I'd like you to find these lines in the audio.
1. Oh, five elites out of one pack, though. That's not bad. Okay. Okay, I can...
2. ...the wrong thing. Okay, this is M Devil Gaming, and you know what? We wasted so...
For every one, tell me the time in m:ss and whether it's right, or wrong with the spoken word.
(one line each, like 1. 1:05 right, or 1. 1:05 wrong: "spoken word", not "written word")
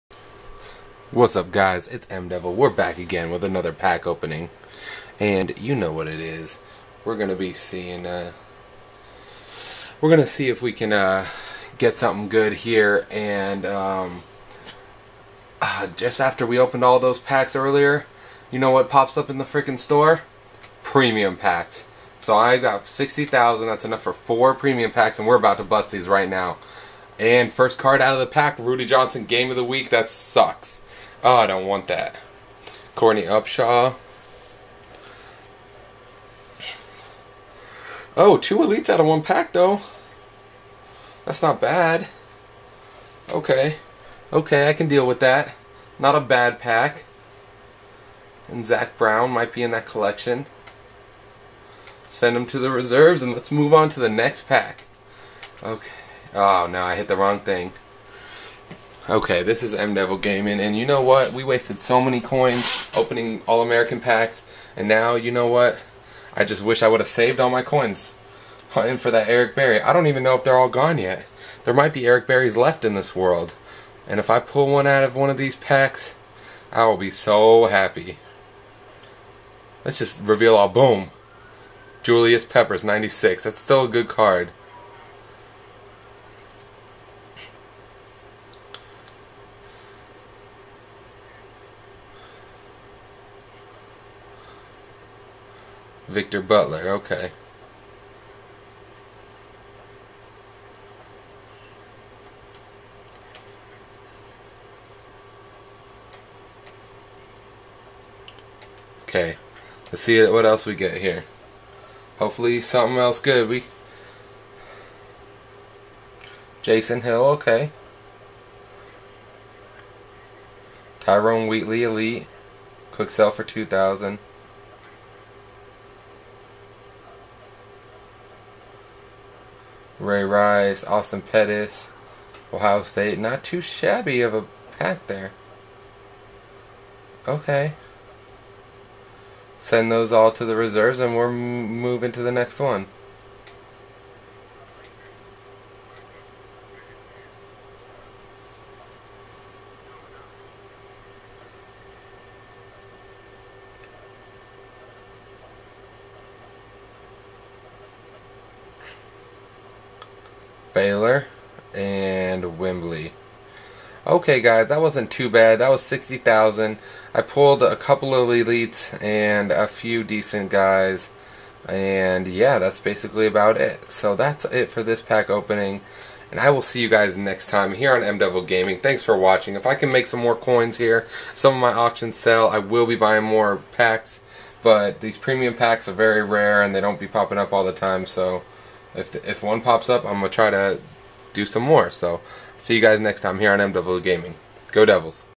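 1. 0:38 wrong: "two", not "five"
2. 0:57 right.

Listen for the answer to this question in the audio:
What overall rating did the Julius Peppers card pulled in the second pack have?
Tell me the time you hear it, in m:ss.
1:22.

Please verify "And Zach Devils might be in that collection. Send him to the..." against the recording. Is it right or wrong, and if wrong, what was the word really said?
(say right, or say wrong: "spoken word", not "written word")
wrong: "Brown", not "Devils".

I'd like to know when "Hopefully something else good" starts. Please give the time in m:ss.
1:52.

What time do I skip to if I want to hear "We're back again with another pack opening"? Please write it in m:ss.
0:02.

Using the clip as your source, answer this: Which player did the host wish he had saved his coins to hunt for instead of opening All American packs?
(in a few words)
Eric Berry.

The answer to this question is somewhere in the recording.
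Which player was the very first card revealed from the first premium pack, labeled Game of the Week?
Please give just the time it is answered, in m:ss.
0:28.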